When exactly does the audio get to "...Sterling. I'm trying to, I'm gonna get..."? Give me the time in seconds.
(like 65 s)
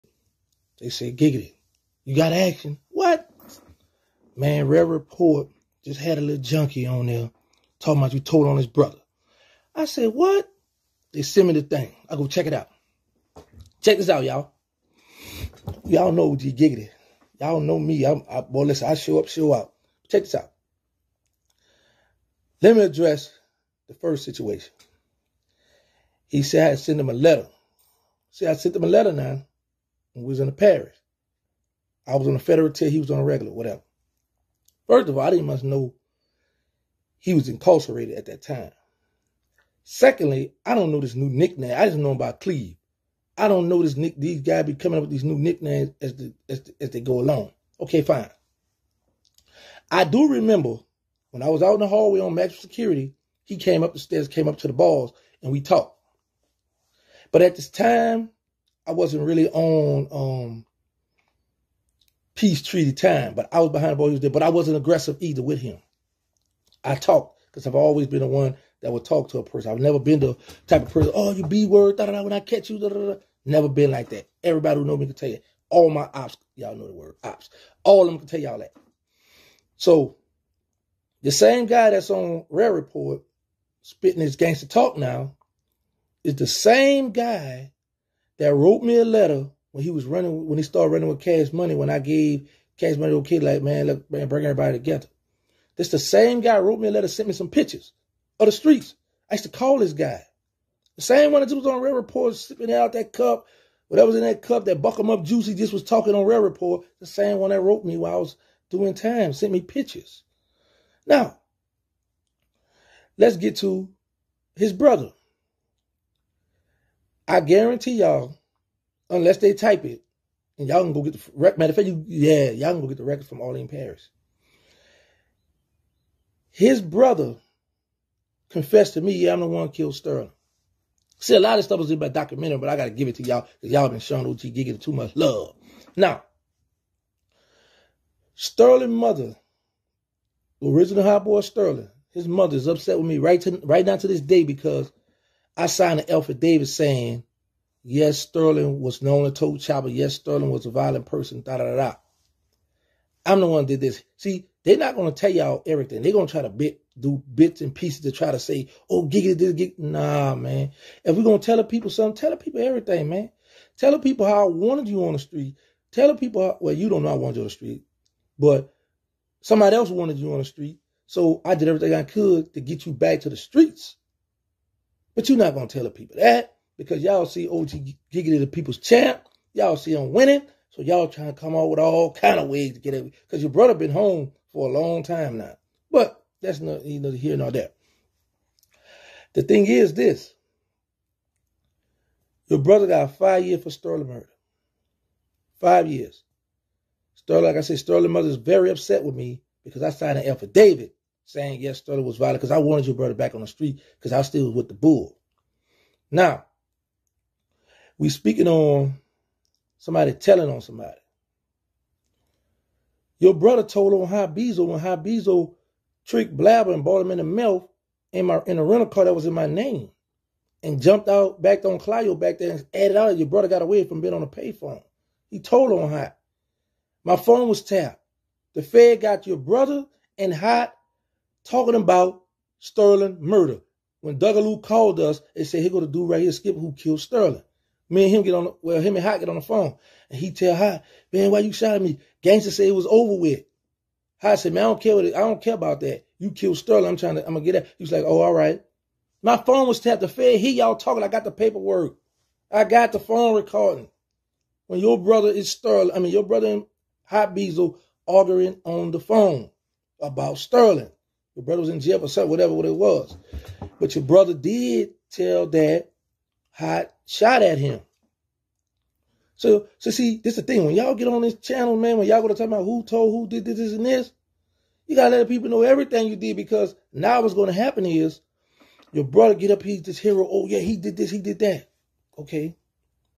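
246 s.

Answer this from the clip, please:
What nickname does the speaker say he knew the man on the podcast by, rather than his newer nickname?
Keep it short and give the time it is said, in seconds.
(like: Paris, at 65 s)
Cleav, at 42 s.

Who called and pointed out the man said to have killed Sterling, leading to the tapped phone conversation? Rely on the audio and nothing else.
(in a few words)
Dougaloo.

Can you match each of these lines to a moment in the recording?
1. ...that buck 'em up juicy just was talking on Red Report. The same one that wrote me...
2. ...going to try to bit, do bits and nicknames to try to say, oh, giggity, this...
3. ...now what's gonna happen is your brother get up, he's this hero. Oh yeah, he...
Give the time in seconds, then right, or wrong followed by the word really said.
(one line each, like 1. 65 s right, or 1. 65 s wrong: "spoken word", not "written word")
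1. 104 s right
2. 156 s wrong: "pieces", not "nicknames"
3. 276 s right.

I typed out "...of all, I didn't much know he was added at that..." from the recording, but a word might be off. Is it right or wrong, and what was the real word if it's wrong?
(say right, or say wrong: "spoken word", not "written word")
wrong: "incarcerated", not "added".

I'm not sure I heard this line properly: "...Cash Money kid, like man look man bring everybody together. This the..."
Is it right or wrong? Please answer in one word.
right.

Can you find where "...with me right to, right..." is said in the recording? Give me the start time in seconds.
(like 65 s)
142 s.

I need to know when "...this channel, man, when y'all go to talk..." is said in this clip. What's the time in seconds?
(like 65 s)
271 s.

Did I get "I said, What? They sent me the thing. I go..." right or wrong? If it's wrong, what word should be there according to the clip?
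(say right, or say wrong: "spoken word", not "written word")
right.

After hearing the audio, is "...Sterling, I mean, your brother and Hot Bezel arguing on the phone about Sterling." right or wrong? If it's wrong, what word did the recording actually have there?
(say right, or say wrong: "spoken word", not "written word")
right.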